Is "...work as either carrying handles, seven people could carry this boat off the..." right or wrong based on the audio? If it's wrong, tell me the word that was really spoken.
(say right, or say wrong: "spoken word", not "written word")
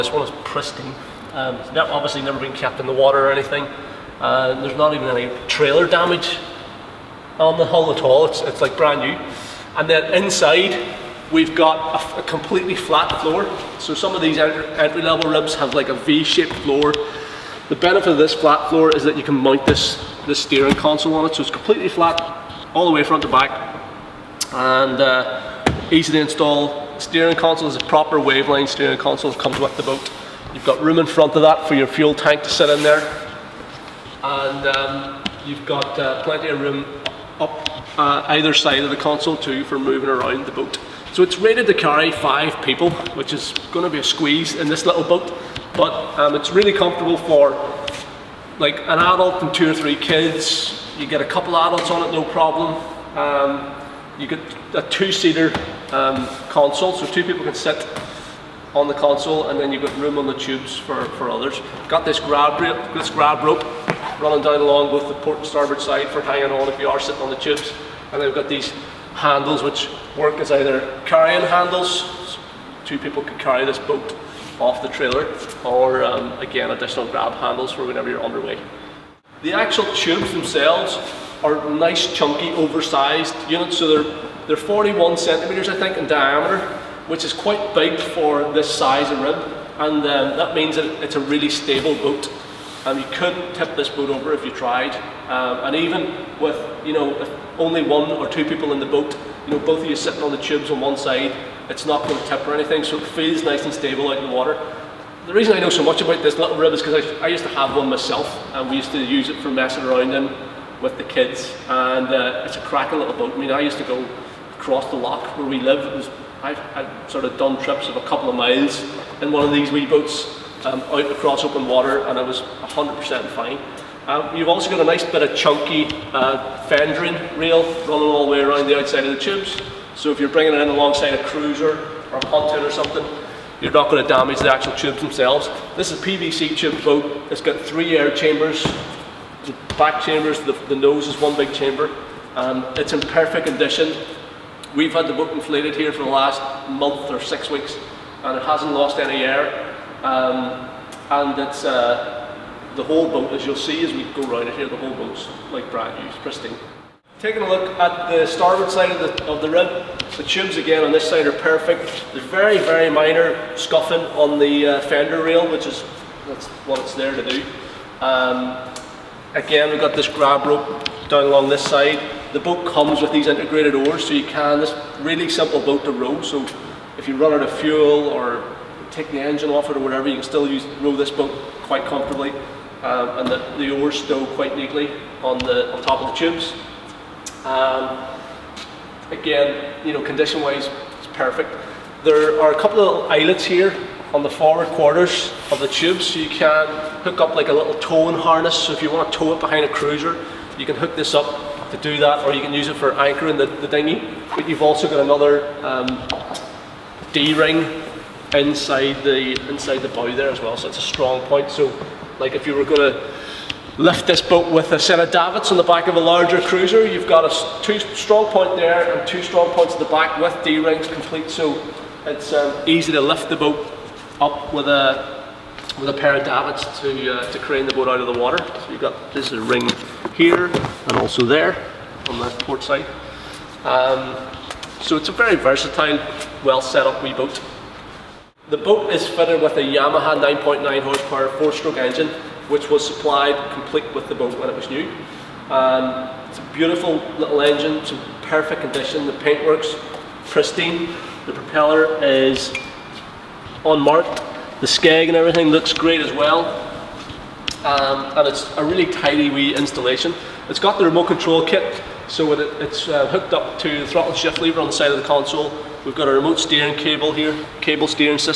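wrong: "two", not "seven".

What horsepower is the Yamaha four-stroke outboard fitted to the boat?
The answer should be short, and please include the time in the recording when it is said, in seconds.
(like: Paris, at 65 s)
9.9, at 240 s.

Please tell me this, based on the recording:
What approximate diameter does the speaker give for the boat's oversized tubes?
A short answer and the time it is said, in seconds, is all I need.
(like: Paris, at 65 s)
41 centimeters, at 84 s.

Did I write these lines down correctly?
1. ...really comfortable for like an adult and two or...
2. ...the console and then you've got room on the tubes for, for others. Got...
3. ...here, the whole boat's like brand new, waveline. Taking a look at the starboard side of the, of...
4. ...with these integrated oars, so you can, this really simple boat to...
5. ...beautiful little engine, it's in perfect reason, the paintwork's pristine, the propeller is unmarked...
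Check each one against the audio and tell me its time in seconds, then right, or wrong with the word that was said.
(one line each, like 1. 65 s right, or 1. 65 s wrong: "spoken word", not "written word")
1. 46 s right
2. 58 s right
3. 154 s wrong: "pristine", not "waveline"
4. 173 s right
5. 246 s wrong: "condition", not "reason".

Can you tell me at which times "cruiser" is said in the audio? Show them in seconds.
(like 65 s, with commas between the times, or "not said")
131 s, 199 s, 216 s.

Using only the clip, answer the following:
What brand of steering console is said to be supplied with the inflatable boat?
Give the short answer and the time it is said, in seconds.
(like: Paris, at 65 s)
Waveline, at 28 s.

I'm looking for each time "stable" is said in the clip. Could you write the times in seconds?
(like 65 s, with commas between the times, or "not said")
91 s, 103 s.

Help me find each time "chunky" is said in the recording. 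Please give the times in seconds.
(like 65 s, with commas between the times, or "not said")
82 s, 125 s.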